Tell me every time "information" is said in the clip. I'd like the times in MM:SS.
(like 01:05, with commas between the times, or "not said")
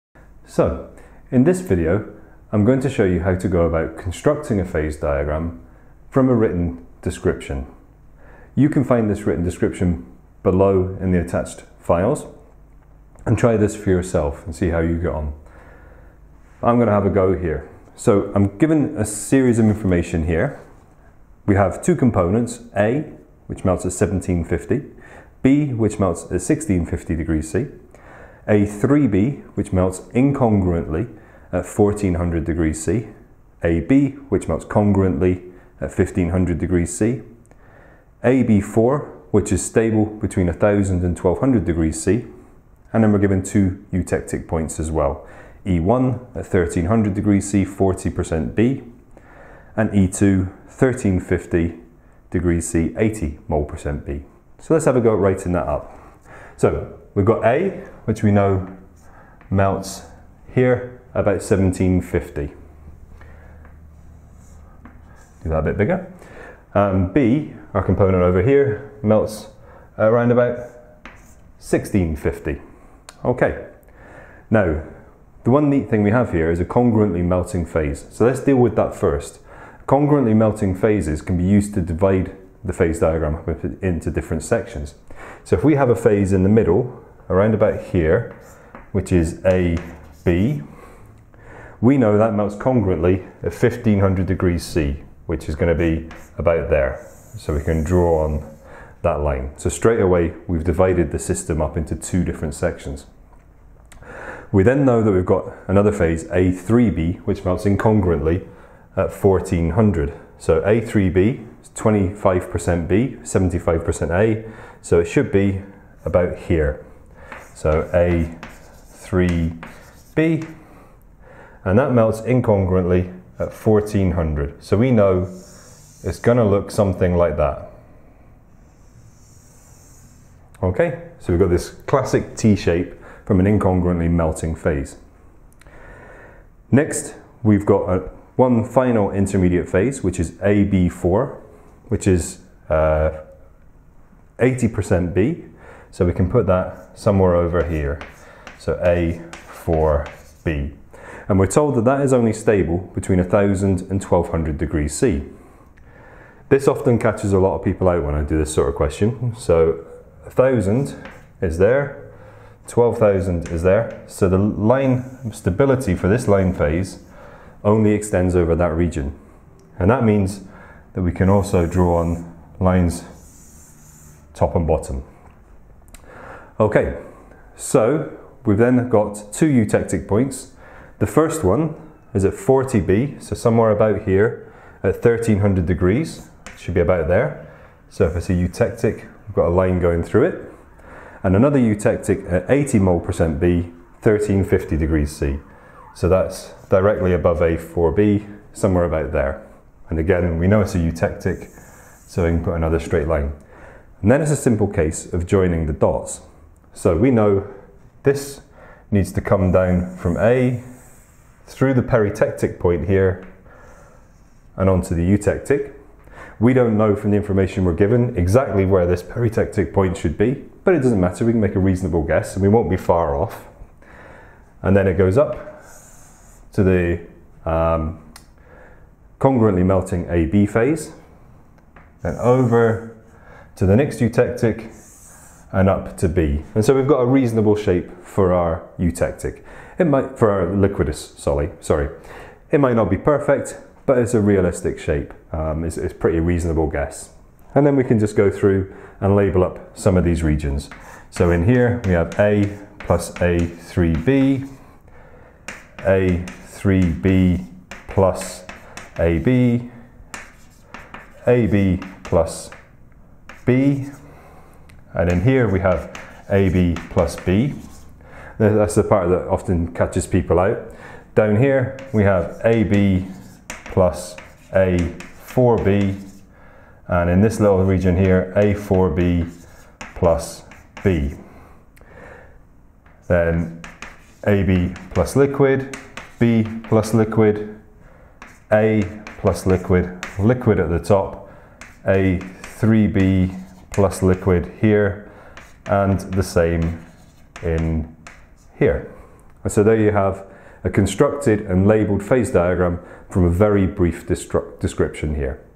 00:19, 03:37.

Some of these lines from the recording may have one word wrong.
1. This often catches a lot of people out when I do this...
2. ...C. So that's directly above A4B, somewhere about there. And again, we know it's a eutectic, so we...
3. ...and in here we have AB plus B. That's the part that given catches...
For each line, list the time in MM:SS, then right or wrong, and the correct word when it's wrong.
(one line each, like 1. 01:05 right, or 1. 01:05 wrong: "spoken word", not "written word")
1. 02:36 right
2. 03:15 right
3. 04:24 wrong: "often", not "given".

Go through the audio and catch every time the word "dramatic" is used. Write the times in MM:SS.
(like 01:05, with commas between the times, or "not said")
not said.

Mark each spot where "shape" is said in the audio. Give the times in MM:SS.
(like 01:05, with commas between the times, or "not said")
02:12, 03:57, 04:04.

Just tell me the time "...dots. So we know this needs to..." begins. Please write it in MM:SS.
03:25.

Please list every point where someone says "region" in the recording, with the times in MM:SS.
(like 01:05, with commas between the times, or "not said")
02:48, 04:10, 04:37.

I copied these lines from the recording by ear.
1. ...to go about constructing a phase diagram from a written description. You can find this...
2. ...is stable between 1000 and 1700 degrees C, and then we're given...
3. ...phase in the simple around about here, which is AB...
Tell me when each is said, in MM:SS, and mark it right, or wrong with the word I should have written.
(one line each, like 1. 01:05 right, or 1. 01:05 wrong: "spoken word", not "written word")
1. 00:03 right
2. 00:39 wrong: "1200", not "1700"
3. 01:25 wrong: "middle", not "simple".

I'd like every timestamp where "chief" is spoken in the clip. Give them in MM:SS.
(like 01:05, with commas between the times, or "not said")
not said.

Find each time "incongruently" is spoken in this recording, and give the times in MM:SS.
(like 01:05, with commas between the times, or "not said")
00:30, 01:47, 02:02, 02:13.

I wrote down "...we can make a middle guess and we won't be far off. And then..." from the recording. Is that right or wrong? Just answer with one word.
wrong.